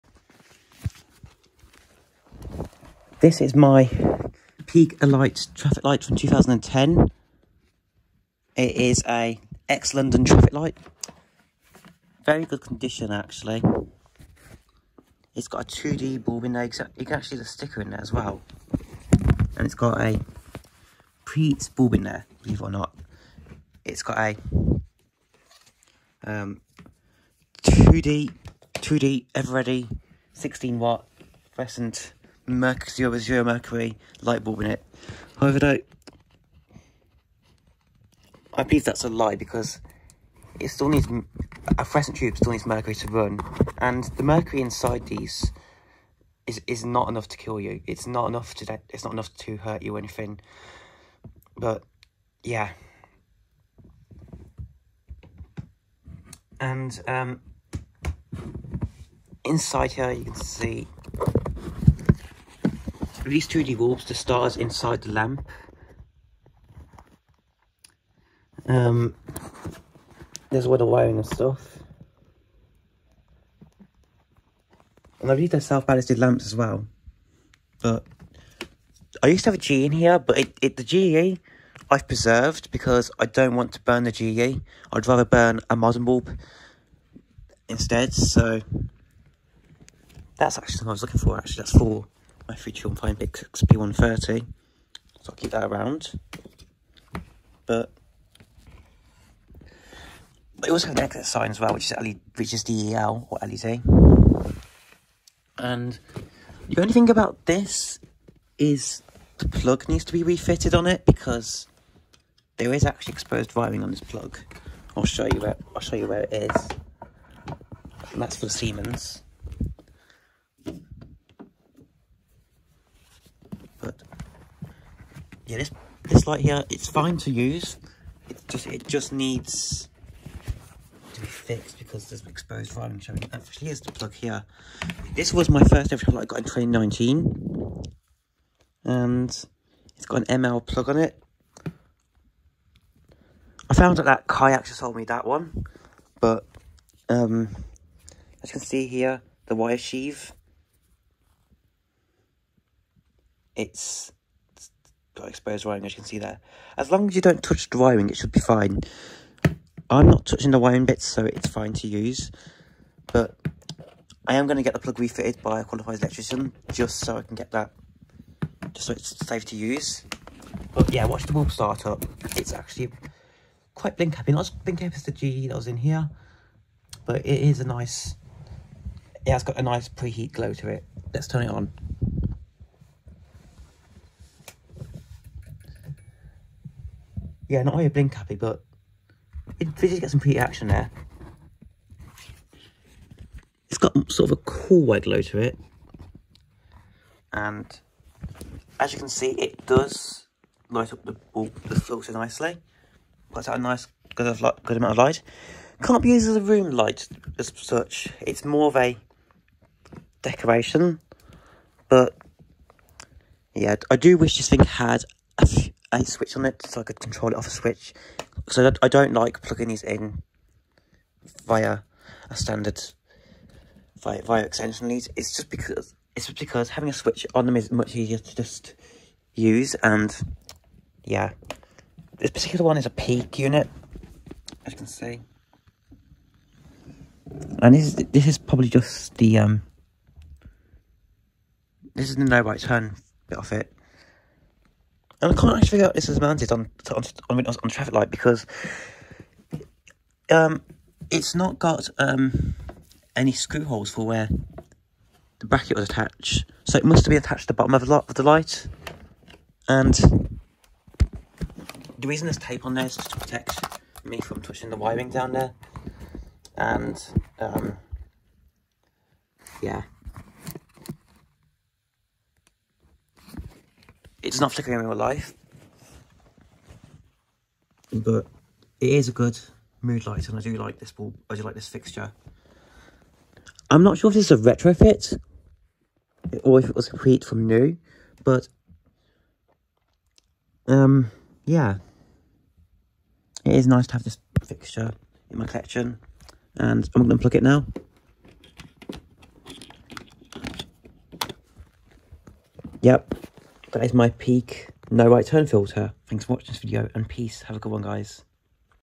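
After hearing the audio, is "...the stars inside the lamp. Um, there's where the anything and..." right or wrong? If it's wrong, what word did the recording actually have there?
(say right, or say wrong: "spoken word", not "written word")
wrong: "wiring", not "anything".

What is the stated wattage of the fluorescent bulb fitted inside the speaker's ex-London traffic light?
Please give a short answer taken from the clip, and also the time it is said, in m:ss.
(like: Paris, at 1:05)
16 watt, at 0:30.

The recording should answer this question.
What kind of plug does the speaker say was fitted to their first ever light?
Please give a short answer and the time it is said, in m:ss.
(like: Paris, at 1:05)
ML plug, at 2:20.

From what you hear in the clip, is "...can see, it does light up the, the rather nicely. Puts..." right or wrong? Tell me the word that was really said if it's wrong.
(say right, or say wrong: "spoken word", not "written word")
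wrong: "filter", not "rather".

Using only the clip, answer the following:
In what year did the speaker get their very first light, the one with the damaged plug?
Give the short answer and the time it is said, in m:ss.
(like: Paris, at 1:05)
2019, at 2:16.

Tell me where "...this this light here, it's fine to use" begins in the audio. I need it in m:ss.
2:05.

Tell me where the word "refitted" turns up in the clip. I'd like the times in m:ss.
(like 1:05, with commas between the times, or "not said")
1:50, 2:44.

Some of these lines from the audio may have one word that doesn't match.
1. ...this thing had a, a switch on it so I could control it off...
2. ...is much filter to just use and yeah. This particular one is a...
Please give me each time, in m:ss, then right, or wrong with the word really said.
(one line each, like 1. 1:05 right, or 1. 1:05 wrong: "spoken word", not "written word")
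1. 3:34 right
2. 3:47 wrong: "easier", not "filter".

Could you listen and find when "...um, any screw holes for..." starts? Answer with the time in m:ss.
4:11.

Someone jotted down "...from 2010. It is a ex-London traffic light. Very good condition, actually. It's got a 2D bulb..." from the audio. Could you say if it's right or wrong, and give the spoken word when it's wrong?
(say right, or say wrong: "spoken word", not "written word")
right.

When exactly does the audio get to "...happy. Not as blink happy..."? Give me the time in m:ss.
2:54.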